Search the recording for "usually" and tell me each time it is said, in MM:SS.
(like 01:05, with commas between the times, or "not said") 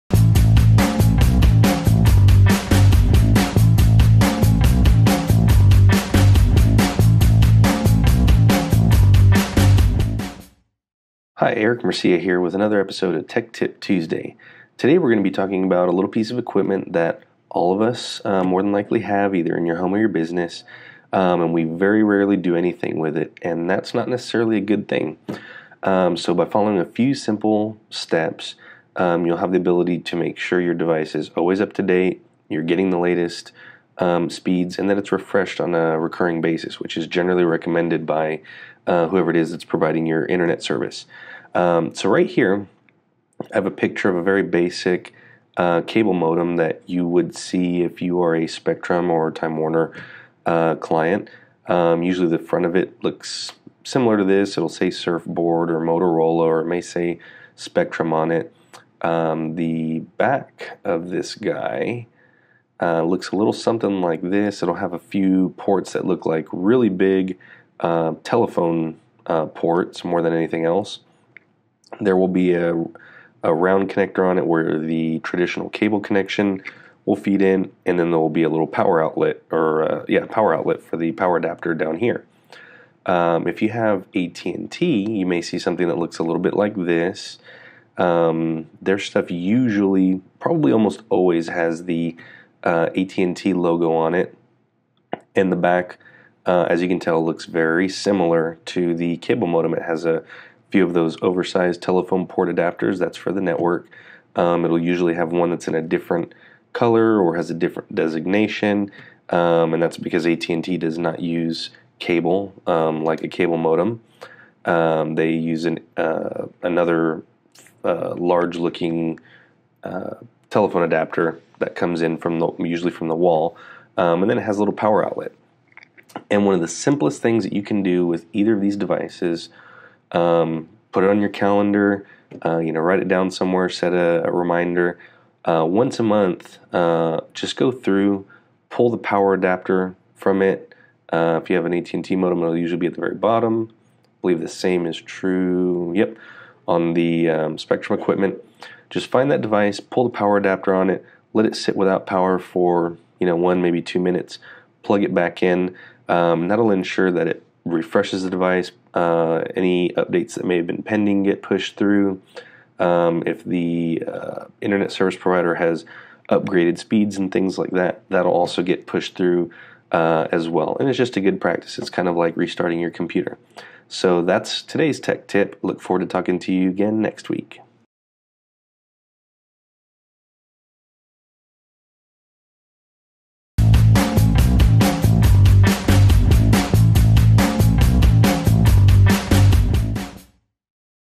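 00:52, 01:29, 01:44, 02:02, 02:22.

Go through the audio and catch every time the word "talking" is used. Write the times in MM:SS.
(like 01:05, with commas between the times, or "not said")
00:15, 02:56.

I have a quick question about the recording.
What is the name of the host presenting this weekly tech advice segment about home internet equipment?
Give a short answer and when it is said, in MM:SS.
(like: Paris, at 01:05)
Eric Mercia, at 00:11.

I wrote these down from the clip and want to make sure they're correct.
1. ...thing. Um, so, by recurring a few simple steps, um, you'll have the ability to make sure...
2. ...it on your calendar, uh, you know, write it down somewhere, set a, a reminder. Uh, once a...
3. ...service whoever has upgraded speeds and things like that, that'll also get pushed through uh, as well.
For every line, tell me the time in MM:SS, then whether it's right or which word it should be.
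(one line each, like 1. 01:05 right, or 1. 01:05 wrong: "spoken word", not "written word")
1. 00:24 wrong: "following", not "recurring"
2. 02:11 right
3. 02:44 wrong: "provider", not "whoever".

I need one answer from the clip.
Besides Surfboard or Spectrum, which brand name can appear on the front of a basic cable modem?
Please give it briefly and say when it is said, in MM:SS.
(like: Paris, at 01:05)
Motorola, at 00:55.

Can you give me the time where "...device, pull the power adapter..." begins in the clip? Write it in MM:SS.
02:29.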